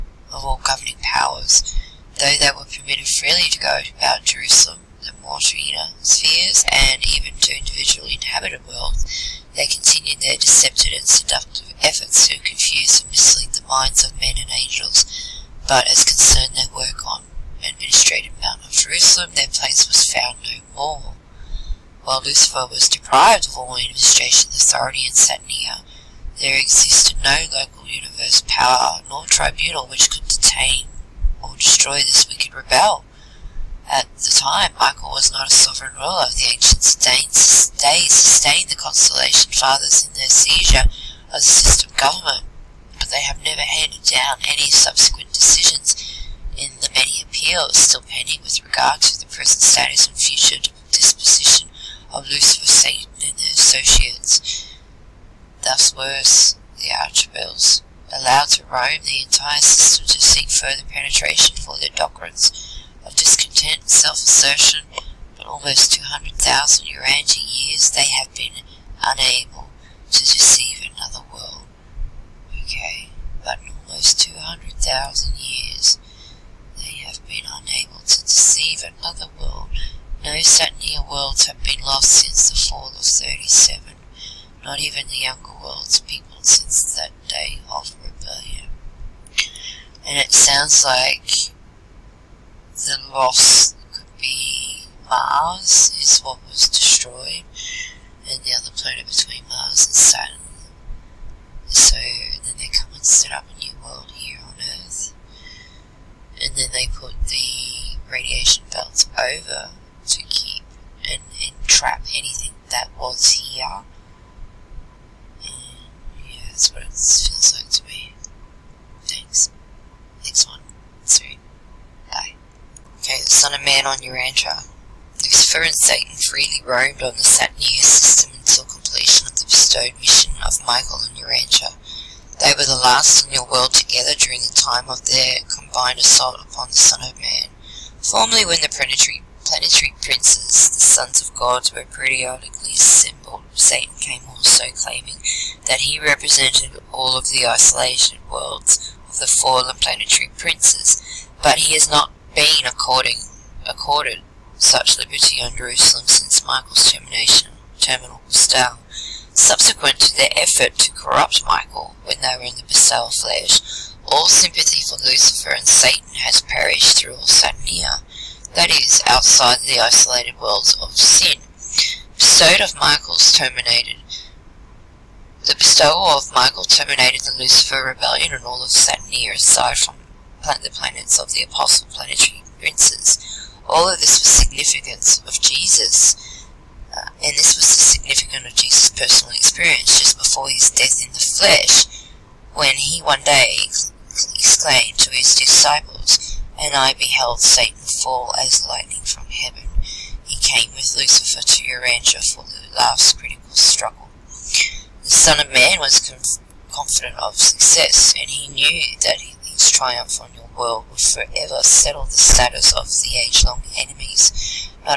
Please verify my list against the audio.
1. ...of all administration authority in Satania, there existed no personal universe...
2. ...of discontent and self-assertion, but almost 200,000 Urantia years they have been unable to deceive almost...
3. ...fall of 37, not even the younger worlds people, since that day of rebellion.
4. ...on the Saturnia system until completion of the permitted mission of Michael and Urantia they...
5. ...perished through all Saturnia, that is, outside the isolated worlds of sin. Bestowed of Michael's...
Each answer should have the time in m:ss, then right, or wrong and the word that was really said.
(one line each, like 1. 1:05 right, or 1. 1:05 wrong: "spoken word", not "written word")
1. 0:23 wrong: "local", not "personal"
2. 1:03 right
3. 1:22 right
4. 2:07 wrong: "bestowed", not "permitted"
5. 2:46 right.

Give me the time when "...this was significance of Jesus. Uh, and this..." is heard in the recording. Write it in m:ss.
3:04.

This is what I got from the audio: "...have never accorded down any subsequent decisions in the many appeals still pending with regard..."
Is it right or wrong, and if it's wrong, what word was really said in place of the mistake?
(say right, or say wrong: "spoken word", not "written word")
wrong: "handed", not "accorded".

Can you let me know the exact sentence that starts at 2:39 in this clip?
Subsequent to their effort to corrupt Michael, when in the Bissau flesh.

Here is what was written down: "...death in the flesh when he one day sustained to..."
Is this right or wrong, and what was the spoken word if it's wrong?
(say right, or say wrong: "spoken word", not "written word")
wrong: "exclaimed", not "sustained".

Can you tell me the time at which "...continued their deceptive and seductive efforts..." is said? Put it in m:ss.
0:09.